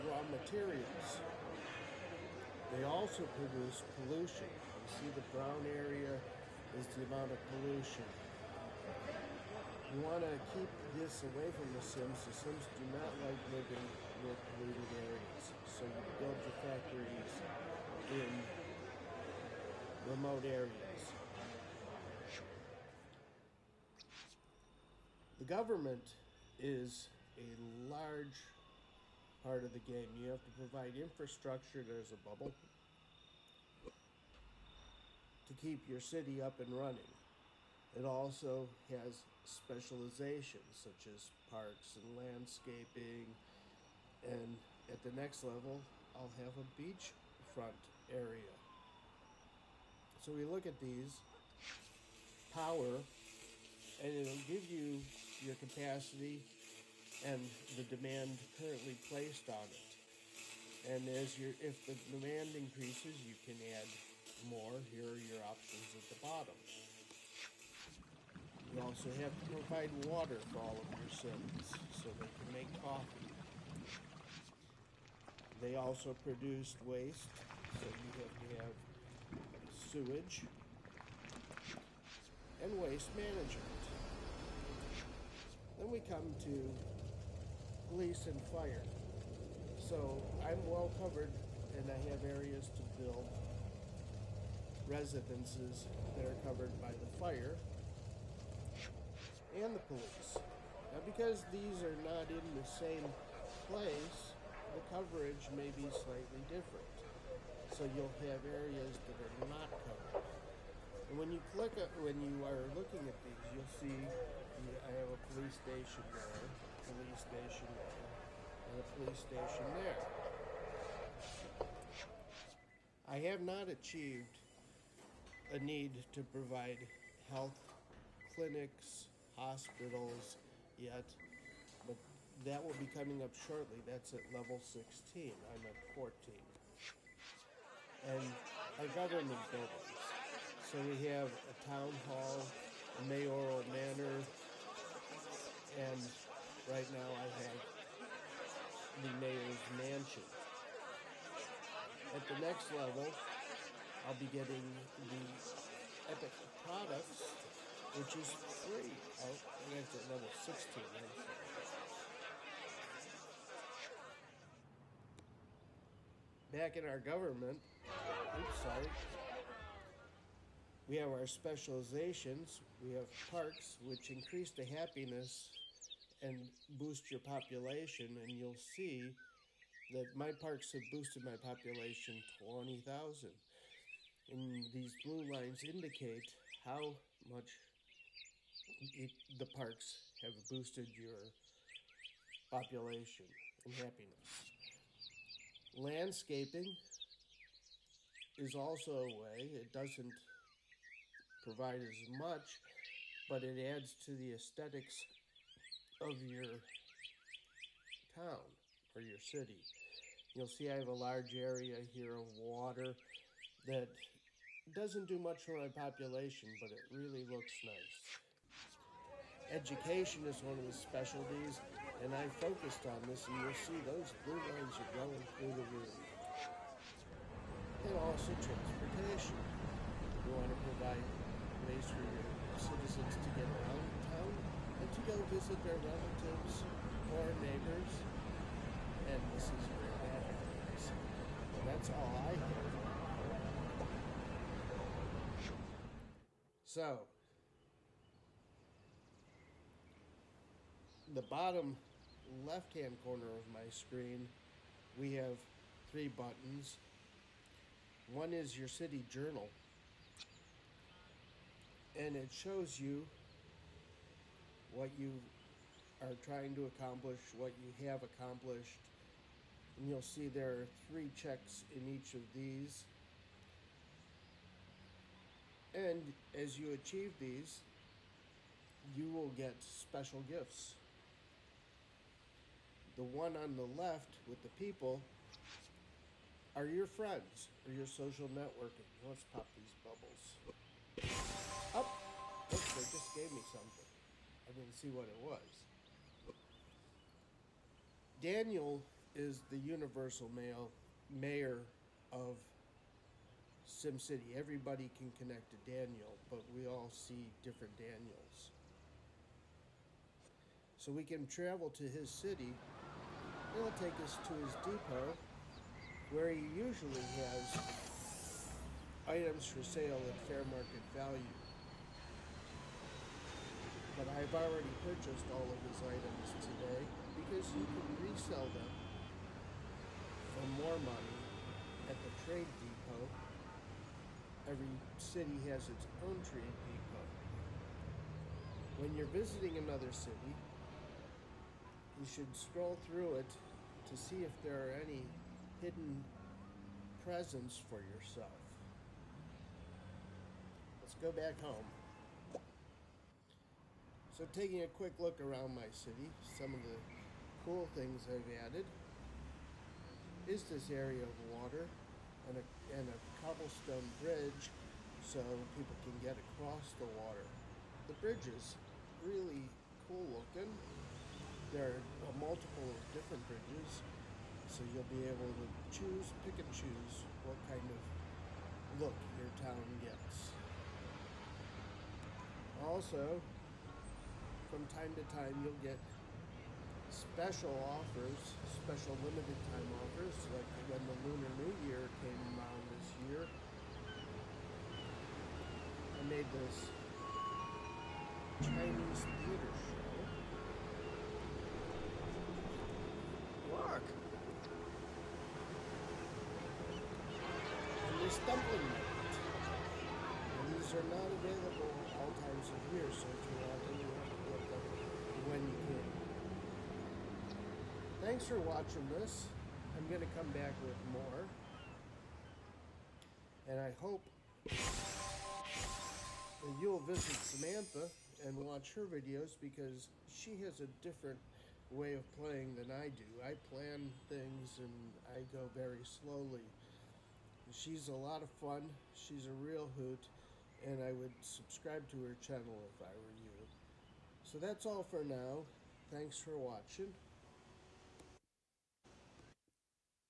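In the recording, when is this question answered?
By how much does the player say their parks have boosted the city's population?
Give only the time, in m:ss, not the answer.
3:02.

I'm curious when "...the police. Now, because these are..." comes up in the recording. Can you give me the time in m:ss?
1:39.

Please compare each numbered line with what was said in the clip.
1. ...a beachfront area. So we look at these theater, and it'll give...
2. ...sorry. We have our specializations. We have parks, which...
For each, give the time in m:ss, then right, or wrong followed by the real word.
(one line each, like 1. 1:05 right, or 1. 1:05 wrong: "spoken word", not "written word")
1. 0:46 wrong: "power", not "theater"
2. 2:48 right.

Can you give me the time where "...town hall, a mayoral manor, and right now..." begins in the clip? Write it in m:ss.
2:21.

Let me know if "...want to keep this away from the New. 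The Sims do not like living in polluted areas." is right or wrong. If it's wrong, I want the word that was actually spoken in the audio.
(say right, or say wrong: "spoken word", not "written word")
wrong: "Sims", not "New".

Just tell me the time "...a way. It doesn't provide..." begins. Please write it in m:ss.
3:19.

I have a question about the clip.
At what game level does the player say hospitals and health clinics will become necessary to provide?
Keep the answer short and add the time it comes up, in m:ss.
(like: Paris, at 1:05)
16, at 2:13.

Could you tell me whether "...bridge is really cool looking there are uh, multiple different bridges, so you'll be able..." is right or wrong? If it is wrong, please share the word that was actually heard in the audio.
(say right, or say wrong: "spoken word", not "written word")
right.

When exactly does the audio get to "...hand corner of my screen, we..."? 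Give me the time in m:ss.
4:12.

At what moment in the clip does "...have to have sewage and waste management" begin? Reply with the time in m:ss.
1:18.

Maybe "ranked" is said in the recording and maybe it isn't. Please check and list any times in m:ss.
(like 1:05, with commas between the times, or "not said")
2:39.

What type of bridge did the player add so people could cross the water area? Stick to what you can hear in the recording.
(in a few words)
cobblestone bridge.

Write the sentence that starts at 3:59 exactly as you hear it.
And this is where that happens.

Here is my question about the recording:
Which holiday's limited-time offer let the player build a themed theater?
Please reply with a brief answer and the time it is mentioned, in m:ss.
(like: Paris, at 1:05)
Lunar New Year, at 6:31.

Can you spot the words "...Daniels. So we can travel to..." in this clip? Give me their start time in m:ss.
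5:07.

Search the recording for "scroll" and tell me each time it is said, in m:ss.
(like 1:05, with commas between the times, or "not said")
5:42.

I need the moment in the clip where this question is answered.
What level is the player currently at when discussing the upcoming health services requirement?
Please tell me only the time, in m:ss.
2:15.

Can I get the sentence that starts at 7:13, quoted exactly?
I plan things and I go very slowly.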